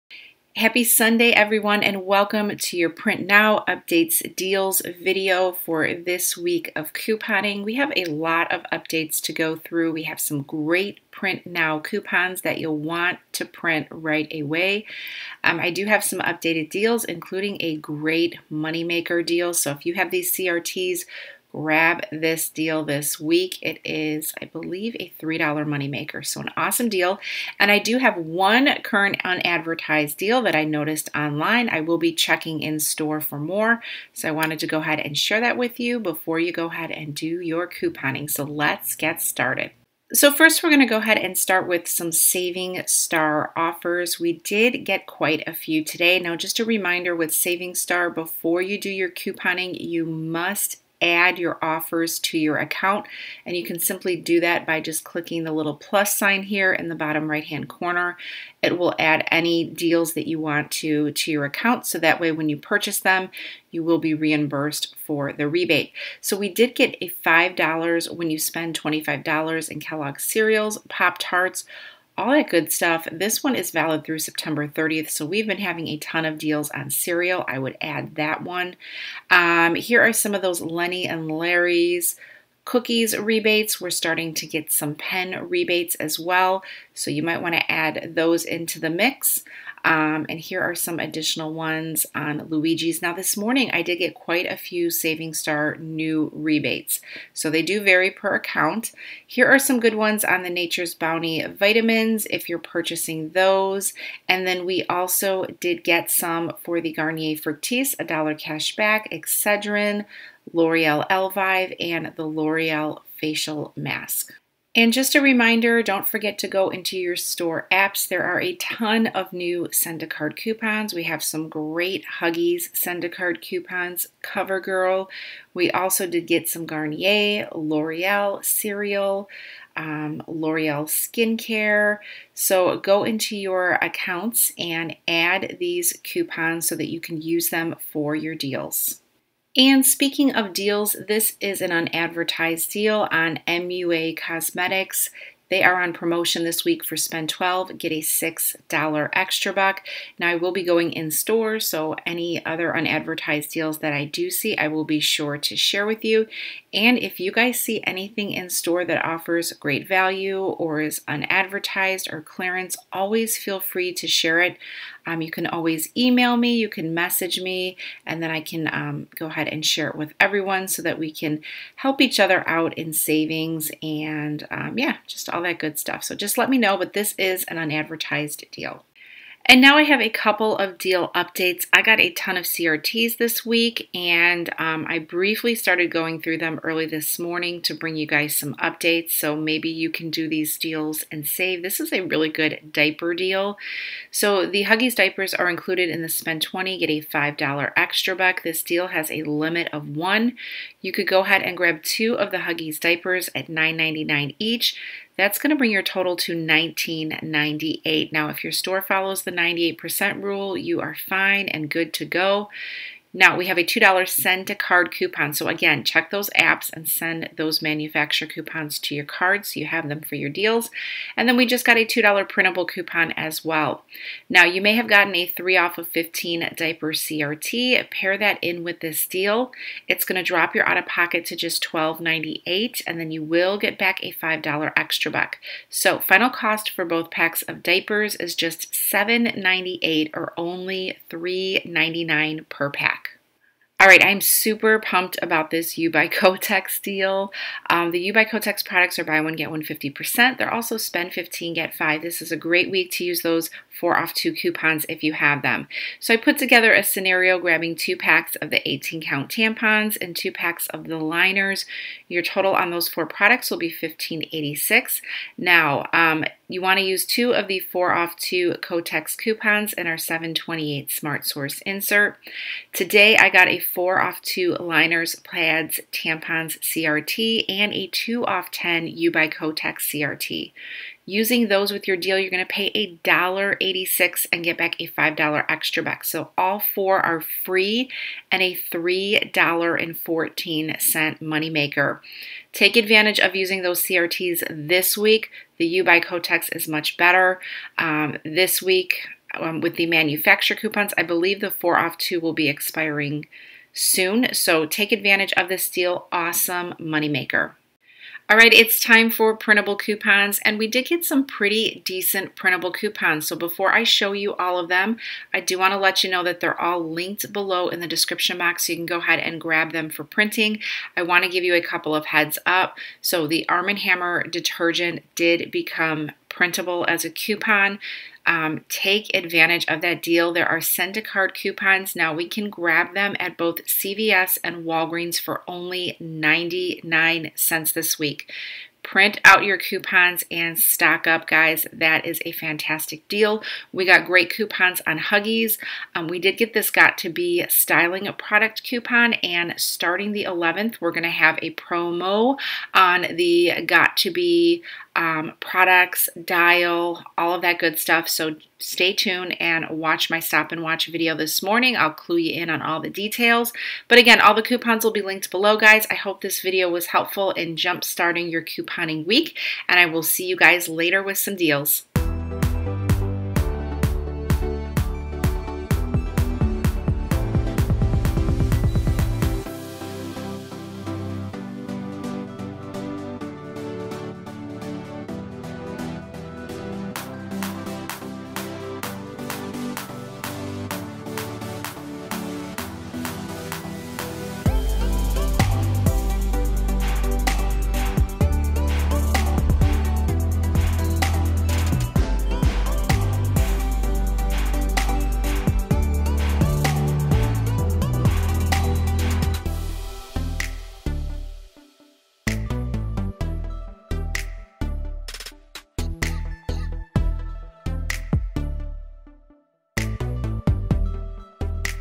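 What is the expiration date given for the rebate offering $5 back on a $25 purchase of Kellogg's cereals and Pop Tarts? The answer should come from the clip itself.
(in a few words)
September 30th.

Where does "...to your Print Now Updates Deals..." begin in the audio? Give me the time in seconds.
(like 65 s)
2 s.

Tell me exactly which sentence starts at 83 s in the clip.
We're starting to get some pen rebates as well.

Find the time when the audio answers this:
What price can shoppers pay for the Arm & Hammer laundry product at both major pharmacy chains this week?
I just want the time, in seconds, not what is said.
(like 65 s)
335 s.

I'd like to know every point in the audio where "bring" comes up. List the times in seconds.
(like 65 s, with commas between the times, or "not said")
187 s, 205 s.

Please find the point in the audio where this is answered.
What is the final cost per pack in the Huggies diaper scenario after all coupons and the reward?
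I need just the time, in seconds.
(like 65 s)
241 s.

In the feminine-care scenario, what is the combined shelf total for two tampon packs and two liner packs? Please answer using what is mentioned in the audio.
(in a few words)
$15.86.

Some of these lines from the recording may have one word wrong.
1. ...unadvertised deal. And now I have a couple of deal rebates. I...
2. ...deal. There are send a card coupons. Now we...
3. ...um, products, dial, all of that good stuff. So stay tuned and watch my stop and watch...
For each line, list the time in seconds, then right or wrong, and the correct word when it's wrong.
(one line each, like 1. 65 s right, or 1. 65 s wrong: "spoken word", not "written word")
1. 177 s wrong: "updates", not "rebates"
2. 330 s right
3. 354 s right.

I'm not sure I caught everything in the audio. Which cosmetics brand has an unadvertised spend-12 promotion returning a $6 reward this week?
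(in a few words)
MUA Cosmetics.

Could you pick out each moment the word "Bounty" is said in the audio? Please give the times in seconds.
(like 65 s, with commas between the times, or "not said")
100 s.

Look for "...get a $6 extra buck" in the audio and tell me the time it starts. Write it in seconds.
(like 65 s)
147 s.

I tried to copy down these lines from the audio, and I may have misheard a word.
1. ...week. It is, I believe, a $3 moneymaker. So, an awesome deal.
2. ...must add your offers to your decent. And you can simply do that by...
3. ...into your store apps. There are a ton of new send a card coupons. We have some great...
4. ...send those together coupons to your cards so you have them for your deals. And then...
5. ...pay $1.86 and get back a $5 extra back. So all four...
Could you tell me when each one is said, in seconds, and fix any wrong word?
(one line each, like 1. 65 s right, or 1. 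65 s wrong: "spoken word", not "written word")
1. 23 s right
2. 50 s wrong: "account", not "decent"
3. 116 s right
4. 216 s wrong: "manufacturer", not "together"
5. 282 s right.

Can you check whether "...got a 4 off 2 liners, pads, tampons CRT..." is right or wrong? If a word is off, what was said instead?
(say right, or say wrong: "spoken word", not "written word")
right.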